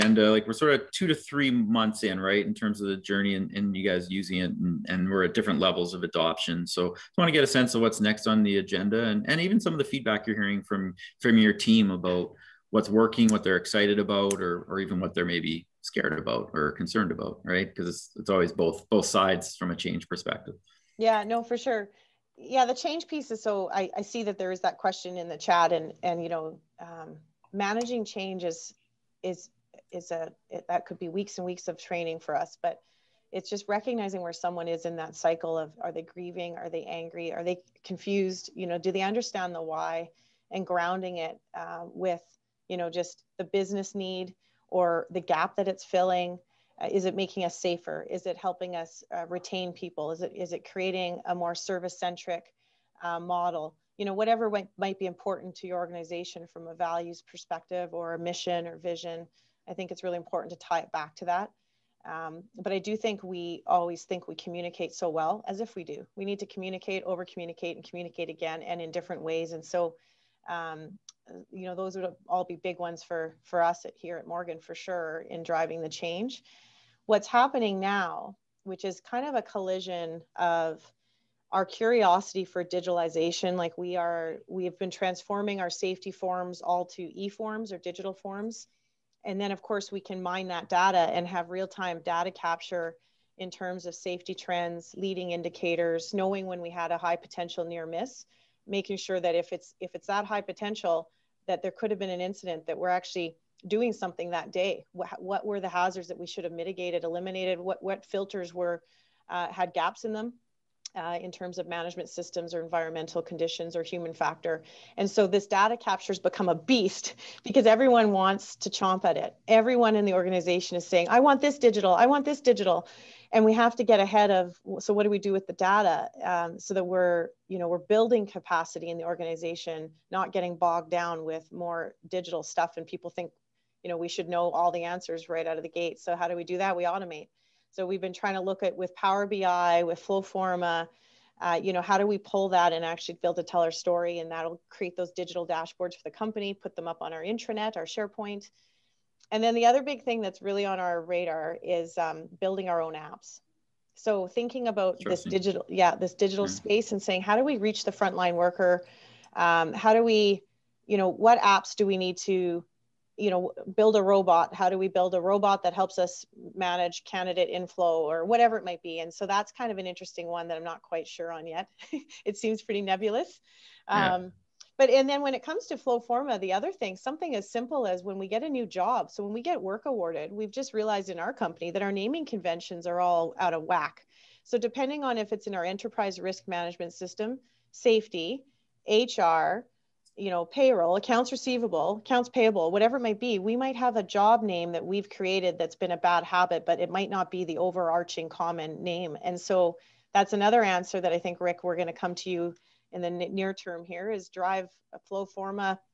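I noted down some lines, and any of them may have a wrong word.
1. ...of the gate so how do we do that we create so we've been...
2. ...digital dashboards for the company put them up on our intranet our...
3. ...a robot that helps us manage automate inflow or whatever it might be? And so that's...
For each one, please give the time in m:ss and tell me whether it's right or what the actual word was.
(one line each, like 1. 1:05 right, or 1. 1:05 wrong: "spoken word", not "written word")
1. 2:15 wrong: "automate", not "create"
2. 2:25 right
3. 2:45 wrong: "candidate", not "automate".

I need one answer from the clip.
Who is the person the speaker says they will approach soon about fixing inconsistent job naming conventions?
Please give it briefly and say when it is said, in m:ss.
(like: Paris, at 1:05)
Rick, at 3:21.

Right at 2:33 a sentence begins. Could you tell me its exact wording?
So thinking about this digital, yeah, this digital mm-hmm.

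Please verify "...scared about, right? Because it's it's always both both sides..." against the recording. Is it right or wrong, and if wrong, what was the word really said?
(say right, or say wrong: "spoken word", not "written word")
wrong: "concerned", not "scared".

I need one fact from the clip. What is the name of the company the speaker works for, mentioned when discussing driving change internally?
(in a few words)
Morgan.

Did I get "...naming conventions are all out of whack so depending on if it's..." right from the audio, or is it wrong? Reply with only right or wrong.
right.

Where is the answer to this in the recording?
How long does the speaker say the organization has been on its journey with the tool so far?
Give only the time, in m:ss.
0:00.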